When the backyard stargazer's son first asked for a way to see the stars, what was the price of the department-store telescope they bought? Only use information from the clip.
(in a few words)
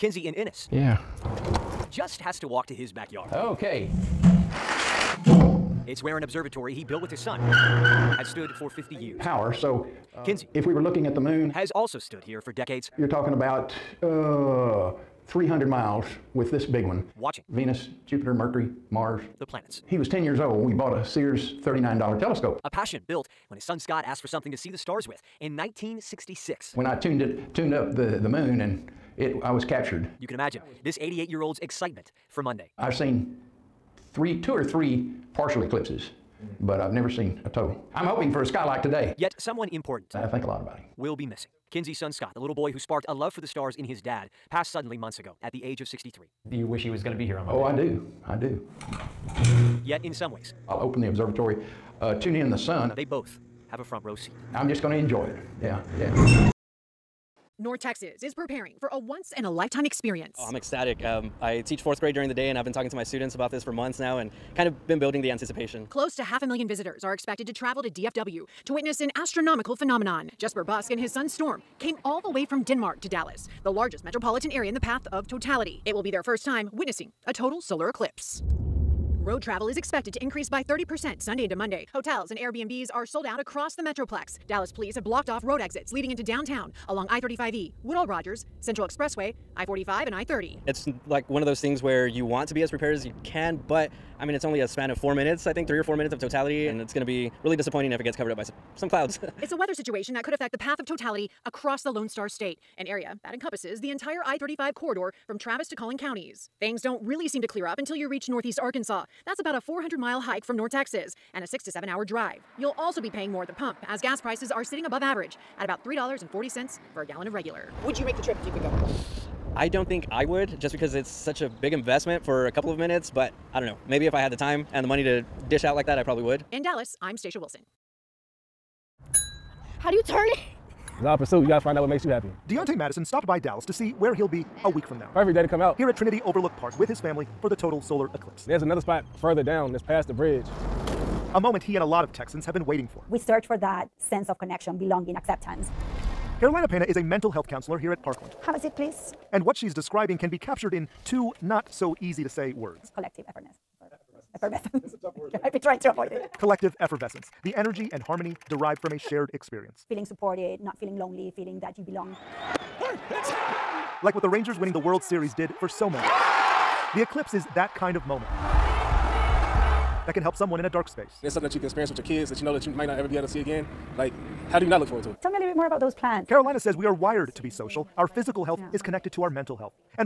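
$39.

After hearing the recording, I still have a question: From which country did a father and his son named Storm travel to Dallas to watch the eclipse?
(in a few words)
Denmark.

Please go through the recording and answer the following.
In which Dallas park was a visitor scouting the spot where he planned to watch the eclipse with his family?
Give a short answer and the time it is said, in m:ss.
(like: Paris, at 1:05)
Trinity Overlook Park, at 2:15.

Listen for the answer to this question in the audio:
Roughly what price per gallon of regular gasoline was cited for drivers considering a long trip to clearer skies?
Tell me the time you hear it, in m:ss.
1:55.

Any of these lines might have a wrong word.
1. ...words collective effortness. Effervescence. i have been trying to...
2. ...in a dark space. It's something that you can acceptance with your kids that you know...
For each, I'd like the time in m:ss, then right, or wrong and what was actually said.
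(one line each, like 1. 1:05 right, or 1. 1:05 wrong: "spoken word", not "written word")
1. 2:32 right
2. 2:50 wrong: "experience", not "acceptance".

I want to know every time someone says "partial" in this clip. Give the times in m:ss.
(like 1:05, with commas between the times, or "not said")
0:35.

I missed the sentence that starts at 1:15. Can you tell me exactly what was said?
It will be their first time witnessing a total solar eclipse road travel is expected to increase by 30% Sunday into Monday.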